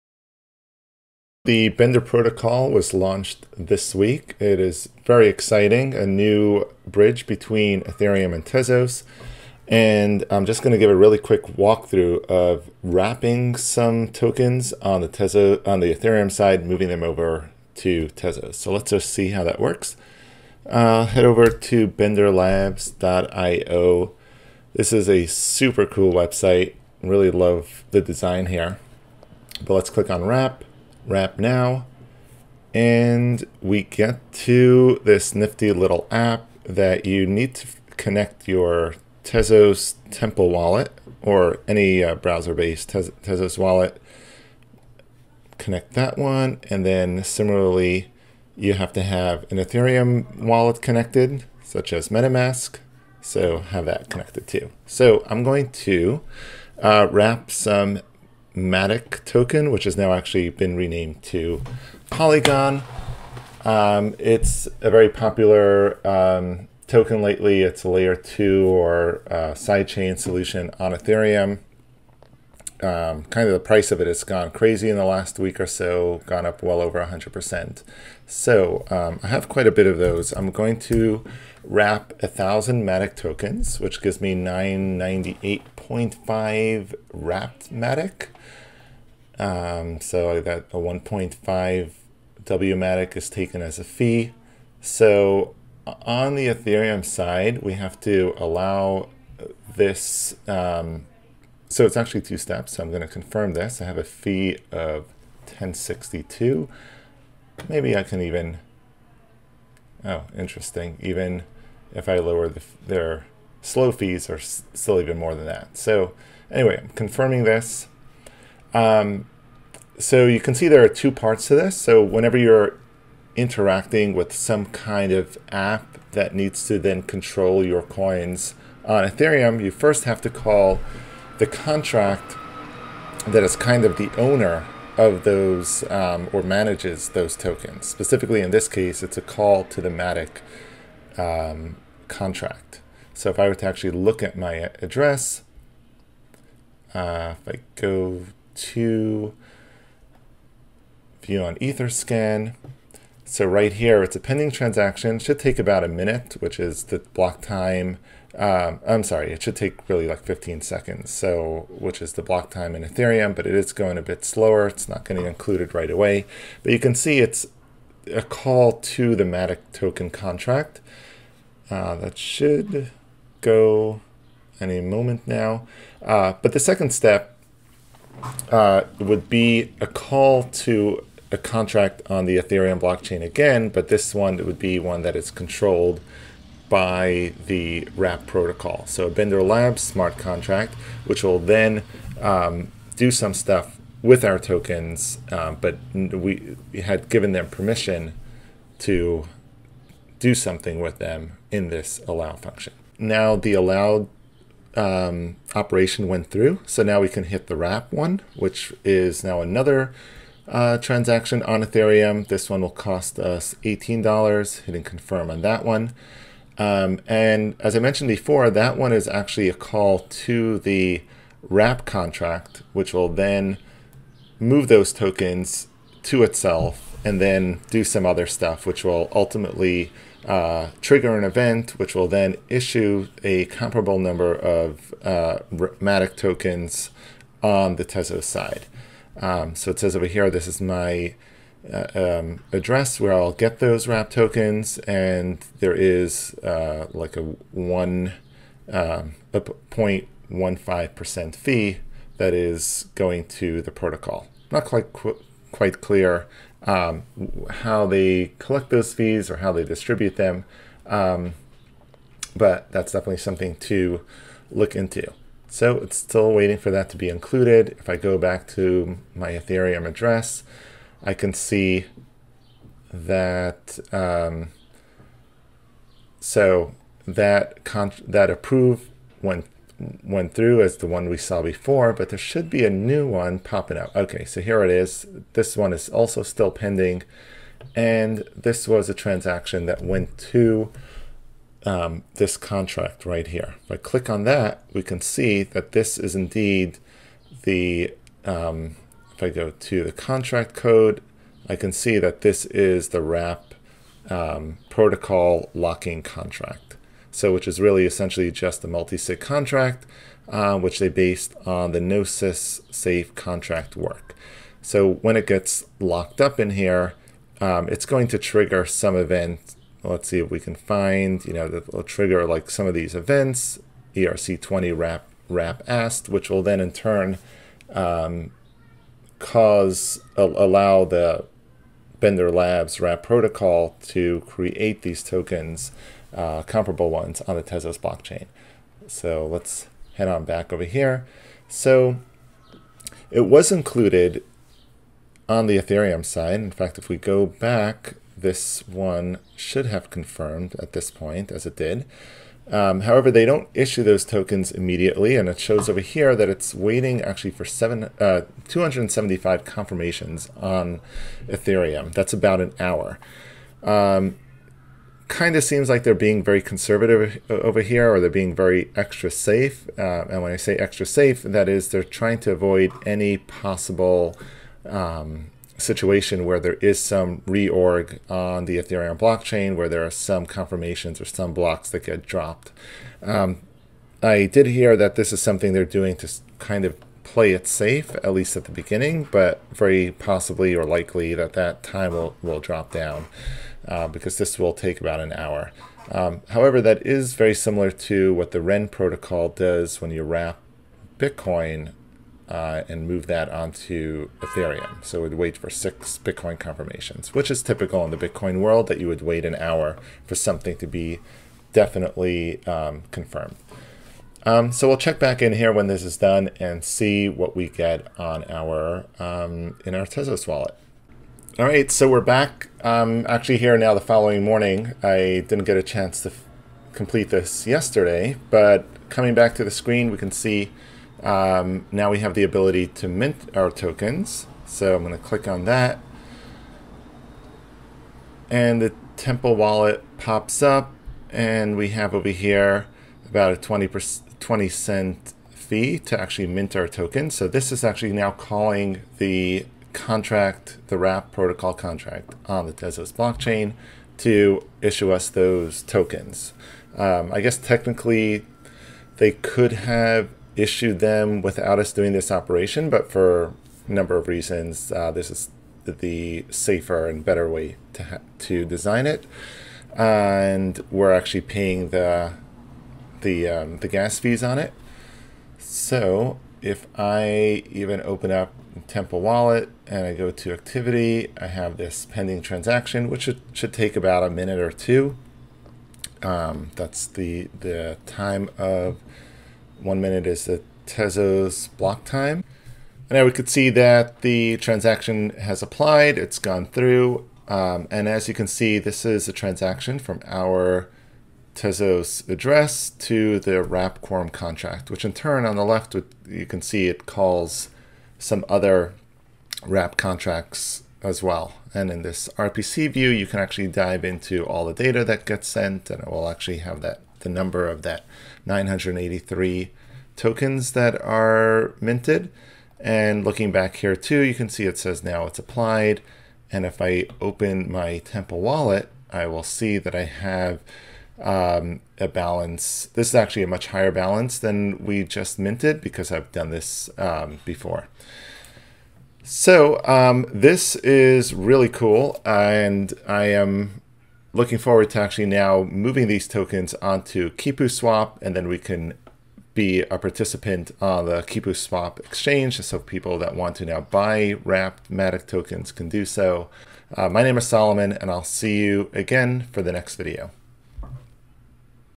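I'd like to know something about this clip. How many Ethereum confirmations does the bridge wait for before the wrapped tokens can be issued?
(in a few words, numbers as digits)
275.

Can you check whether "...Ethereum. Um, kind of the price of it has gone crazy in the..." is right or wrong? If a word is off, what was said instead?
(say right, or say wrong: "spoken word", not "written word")
right.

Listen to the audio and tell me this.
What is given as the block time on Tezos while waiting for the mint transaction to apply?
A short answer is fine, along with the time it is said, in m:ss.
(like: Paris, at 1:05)
one minute, at 8:09.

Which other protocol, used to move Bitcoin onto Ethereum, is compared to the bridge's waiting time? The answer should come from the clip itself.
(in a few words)
REN protocol.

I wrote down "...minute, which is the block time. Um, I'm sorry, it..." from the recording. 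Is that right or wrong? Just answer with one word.
right.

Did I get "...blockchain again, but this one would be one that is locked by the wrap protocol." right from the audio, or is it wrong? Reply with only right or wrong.
wrong.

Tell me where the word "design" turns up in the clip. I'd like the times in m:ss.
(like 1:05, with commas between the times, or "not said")
0:28, 7:48.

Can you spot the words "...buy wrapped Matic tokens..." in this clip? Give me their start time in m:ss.
9:13.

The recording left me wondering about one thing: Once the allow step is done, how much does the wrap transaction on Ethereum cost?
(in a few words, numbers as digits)
$18.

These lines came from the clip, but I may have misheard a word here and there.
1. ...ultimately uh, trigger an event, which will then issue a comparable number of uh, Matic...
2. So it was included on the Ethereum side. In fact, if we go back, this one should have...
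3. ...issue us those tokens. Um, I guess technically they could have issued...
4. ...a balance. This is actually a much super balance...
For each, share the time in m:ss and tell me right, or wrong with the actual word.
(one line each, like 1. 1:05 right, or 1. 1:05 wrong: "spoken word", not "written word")
1. 3:49 right
2. 5:41 right
3. 7:34 right
4. 8:51 wrong: "higher", not "super".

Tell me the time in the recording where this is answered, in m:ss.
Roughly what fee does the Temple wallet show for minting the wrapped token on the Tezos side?
7:24.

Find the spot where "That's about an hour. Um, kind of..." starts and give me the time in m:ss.
6:01.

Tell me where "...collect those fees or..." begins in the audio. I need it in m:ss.
4:18.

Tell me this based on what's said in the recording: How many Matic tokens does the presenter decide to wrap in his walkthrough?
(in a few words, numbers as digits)
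1,000.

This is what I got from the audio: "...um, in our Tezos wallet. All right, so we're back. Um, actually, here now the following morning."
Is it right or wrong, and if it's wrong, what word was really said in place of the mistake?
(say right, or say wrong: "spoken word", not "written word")
right.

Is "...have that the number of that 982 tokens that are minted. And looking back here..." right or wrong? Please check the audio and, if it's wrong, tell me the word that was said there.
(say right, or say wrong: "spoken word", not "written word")
wrong: "983", not "982".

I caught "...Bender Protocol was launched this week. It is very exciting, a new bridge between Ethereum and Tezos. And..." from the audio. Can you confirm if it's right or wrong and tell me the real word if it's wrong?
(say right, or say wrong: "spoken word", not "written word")
right.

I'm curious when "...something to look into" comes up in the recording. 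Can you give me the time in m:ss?
4:23.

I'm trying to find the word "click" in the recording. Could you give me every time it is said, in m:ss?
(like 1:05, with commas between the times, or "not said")
0:29, 4:53, 7:15.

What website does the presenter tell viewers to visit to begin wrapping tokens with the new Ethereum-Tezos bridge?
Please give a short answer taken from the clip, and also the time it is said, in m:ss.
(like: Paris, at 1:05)
benderlabs.io, at 0:21.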